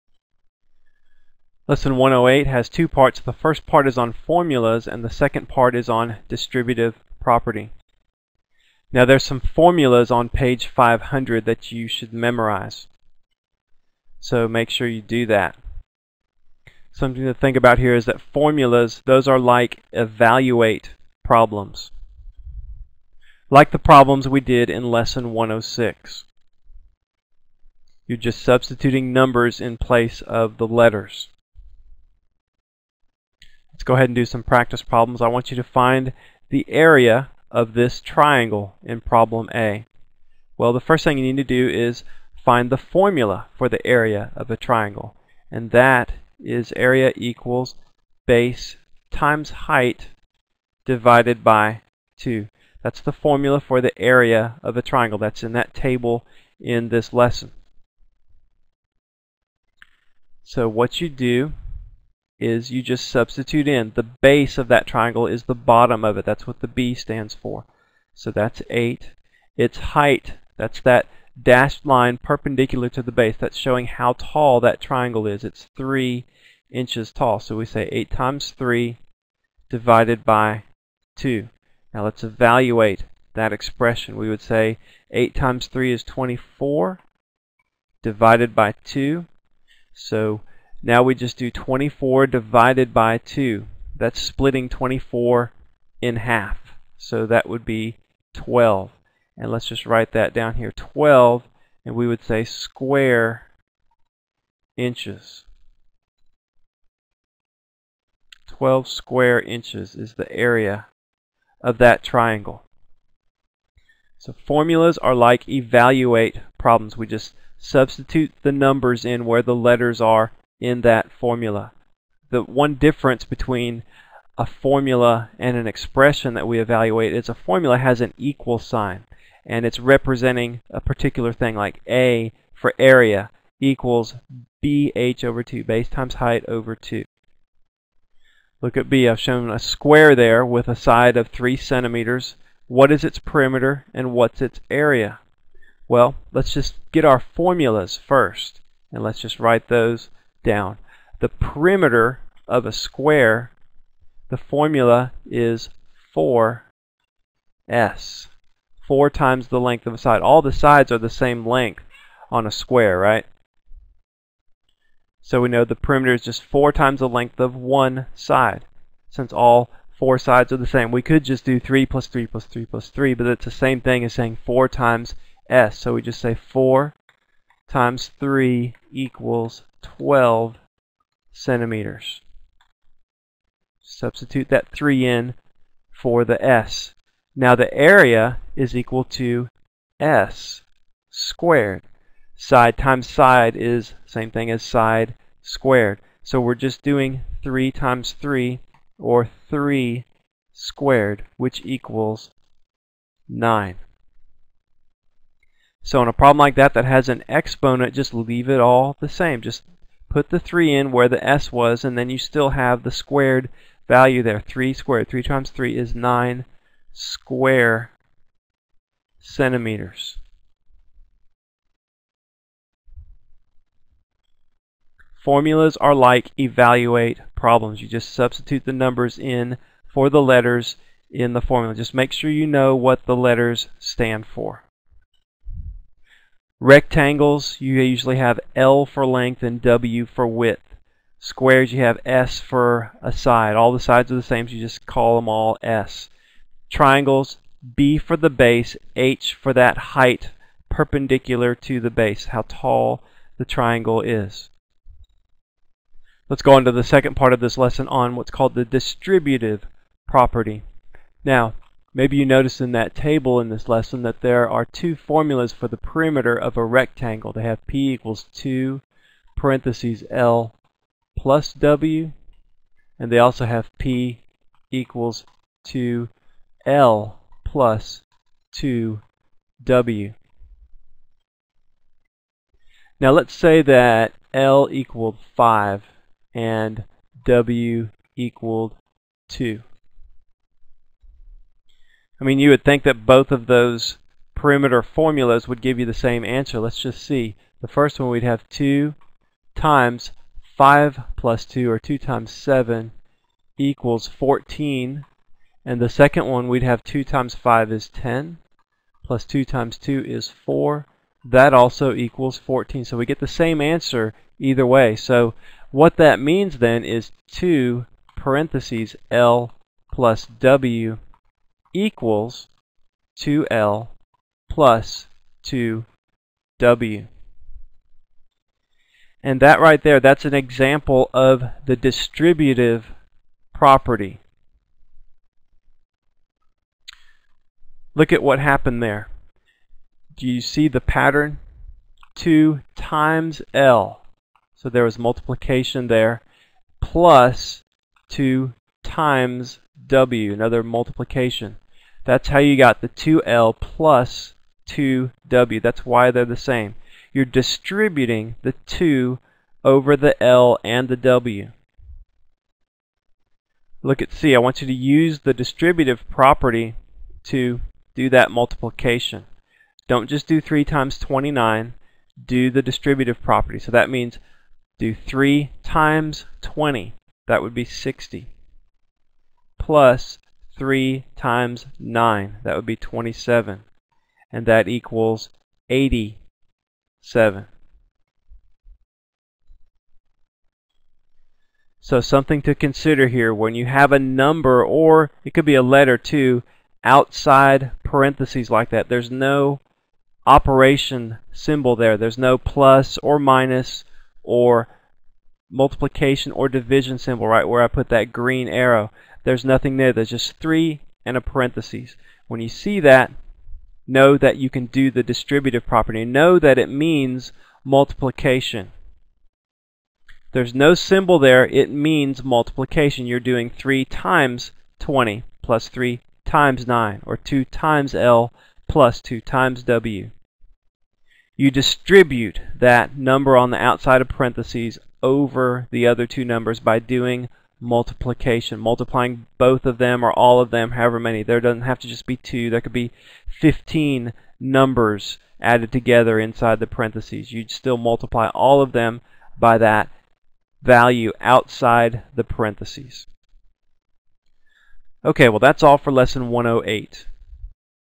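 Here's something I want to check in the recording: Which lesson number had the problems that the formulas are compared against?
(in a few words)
106.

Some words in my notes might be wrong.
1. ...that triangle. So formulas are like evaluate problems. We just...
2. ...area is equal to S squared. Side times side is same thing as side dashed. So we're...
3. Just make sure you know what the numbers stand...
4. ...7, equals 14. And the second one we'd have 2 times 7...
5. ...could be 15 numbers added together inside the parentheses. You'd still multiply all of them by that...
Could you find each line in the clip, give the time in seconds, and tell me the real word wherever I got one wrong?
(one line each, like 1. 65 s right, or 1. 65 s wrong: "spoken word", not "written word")
1. 111 s right
2. 187 s wrong: "squared", not "dashed"
3. 231 s wrong: "letters", not "numbers"
4. 302 s wrong: "5", not "7"
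5. 442 s right.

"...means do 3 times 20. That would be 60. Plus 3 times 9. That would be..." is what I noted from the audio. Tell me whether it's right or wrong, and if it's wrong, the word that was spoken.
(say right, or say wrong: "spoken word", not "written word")
right.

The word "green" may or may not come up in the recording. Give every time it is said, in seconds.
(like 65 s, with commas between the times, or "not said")
408 s.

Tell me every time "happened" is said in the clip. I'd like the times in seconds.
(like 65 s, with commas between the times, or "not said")
338 s.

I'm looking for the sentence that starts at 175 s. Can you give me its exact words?
So we just say 4 times 3 equals 12 centimeters.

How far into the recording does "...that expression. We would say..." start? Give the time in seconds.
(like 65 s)
83 s.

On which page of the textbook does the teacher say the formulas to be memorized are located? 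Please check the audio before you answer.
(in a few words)
500.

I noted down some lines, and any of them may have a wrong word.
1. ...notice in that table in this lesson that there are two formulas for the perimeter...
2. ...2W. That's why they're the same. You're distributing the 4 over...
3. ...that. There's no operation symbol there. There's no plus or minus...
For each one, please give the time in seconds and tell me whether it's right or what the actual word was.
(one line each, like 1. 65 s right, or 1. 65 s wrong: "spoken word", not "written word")
1. 262 s right
2. 354 s wrong: "2", not "4"
3. 398 s right.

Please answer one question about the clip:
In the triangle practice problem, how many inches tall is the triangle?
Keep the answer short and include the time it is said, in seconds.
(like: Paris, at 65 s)
3, at 75 s.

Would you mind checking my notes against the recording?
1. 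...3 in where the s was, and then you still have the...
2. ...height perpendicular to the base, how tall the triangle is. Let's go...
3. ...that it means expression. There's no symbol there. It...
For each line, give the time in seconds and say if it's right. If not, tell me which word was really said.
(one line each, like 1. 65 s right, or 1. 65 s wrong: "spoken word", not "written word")
1. 210 s right
2. 249 s right
3. 416 s wrong: "multiplication", not "expression".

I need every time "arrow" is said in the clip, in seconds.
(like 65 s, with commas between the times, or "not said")
408 s.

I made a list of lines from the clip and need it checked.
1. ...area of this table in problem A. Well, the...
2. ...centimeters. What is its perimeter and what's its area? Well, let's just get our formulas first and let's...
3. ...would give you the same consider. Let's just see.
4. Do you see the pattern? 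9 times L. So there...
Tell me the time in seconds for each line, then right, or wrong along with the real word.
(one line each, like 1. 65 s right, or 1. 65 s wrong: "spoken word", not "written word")
1. 36 s wrong: "triangle", not "table"
2. 141 s right
3. 295 s wrong: "answer", not "consider"
4. 340 s wrong: "2", not "9".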